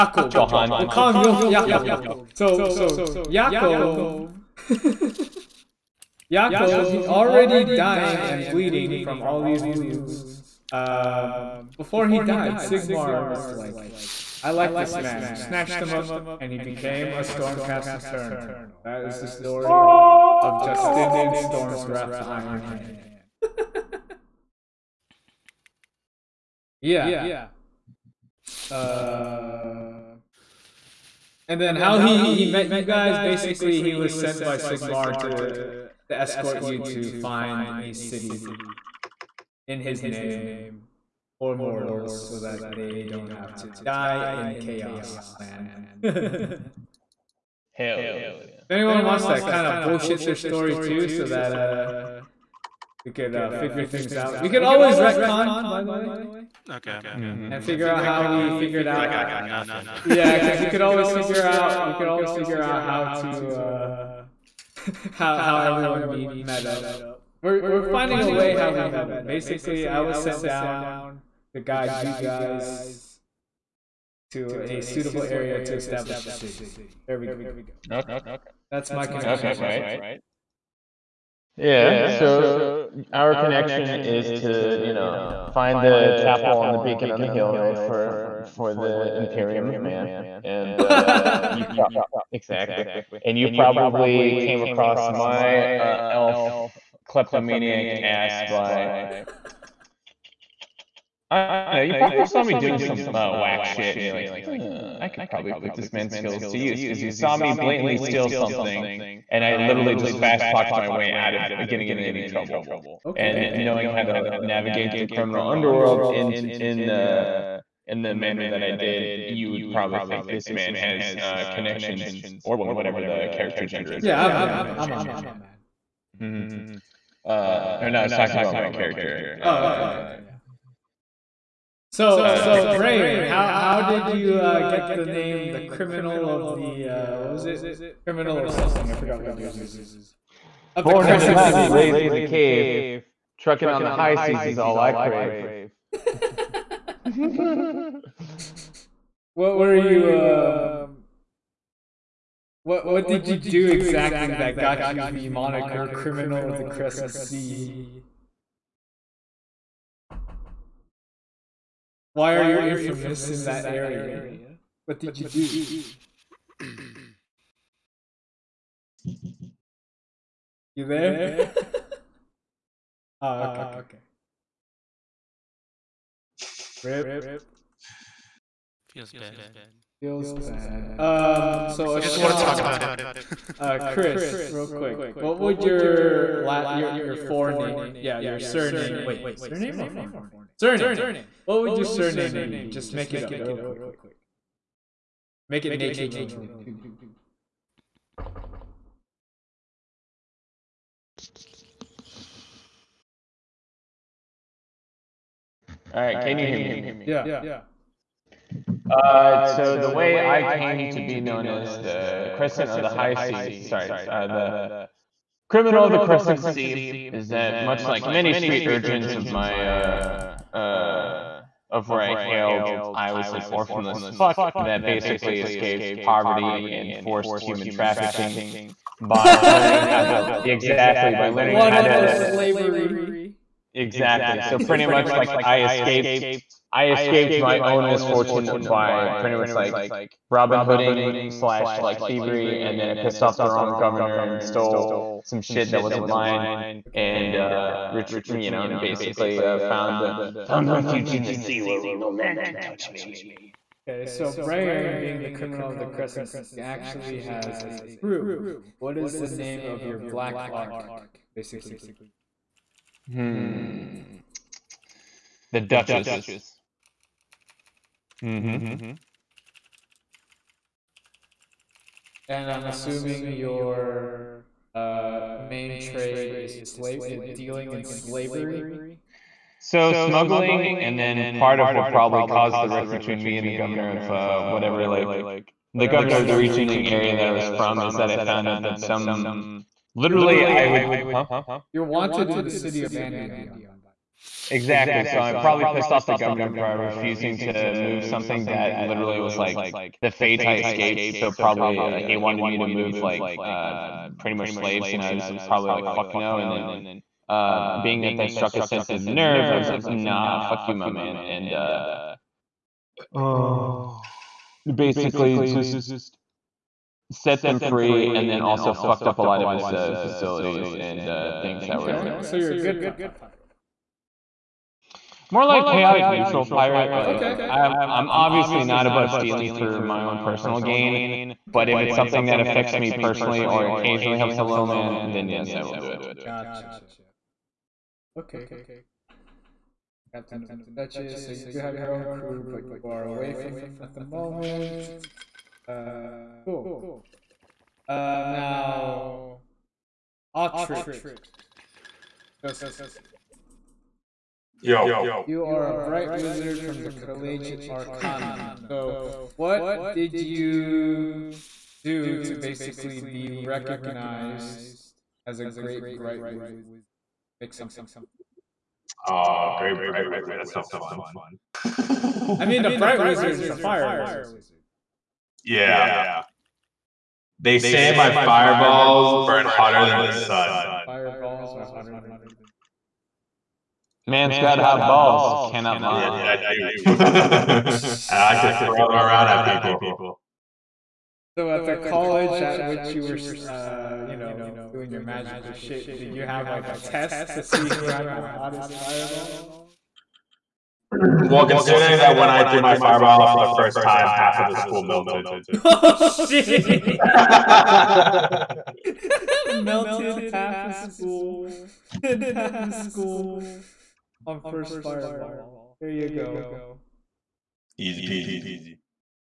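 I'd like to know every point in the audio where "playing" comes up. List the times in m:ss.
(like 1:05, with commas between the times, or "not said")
not said.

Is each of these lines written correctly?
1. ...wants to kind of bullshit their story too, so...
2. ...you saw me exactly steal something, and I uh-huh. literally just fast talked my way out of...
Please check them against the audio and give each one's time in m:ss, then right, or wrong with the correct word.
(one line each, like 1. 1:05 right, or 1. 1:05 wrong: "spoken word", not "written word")
1. 0:49 right
2. 1:47 wrong: "blatantly", not "exactly".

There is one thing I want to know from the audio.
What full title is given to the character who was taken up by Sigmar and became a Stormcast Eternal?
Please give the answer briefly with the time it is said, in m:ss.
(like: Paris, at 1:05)
Justinian Storm's Wrath the Iron Hand, at 0:20.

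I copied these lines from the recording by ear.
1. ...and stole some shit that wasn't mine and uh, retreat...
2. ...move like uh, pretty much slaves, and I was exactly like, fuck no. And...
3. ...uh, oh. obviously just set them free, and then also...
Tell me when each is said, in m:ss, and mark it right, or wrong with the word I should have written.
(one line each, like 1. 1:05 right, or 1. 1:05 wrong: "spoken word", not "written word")
1. 4:04 right
2. 5:02 wrong: "probably", not "exactly"
3. 5:11 wrong: "basically", not "obviously".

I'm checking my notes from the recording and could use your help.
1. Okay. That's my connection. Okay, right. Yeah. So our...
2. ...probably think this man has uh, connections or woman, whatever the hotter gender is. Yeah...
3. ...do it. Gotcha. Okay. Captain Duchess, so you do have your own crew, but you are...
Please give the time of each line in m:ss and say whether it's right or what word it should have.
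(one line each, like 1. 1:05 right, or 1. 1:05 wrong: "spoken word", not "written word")
1. 1:17 right
2. 1:59 wrong: "character", not "hotter"
3. 5:35 right.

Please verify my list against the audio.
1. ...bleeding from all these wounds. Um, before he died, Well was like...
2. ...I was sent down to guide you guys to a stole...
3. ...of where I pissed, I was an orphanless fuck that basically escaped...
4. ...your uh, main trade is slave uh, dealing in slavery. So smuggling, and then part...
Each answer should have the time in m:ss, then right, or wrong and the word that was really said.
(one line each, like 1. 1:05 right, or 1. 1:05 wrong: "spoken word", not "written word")
1. 0:08 wrong: "Sigmar", not "Well"
2. 1:09 wrong: "suitable", not "stole"
3. 3:41 wrong: "hailed", not "pissed"
4. 4:33 right.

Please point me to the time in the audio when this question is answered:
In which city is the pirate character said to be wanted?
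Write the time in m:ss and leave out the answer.
4:52.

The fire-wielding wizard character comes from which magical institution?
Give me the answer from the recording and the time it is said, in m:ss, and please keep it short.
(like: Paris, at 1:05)
Collegiate Arcanum, at 5:56.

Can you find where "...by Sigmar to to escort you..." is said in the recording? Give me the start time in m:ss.
0:34.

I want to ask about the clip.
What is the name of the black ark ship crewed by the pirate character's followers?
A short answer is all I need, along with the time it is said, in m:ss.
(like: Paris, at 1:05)
The Duchess, at 4:25.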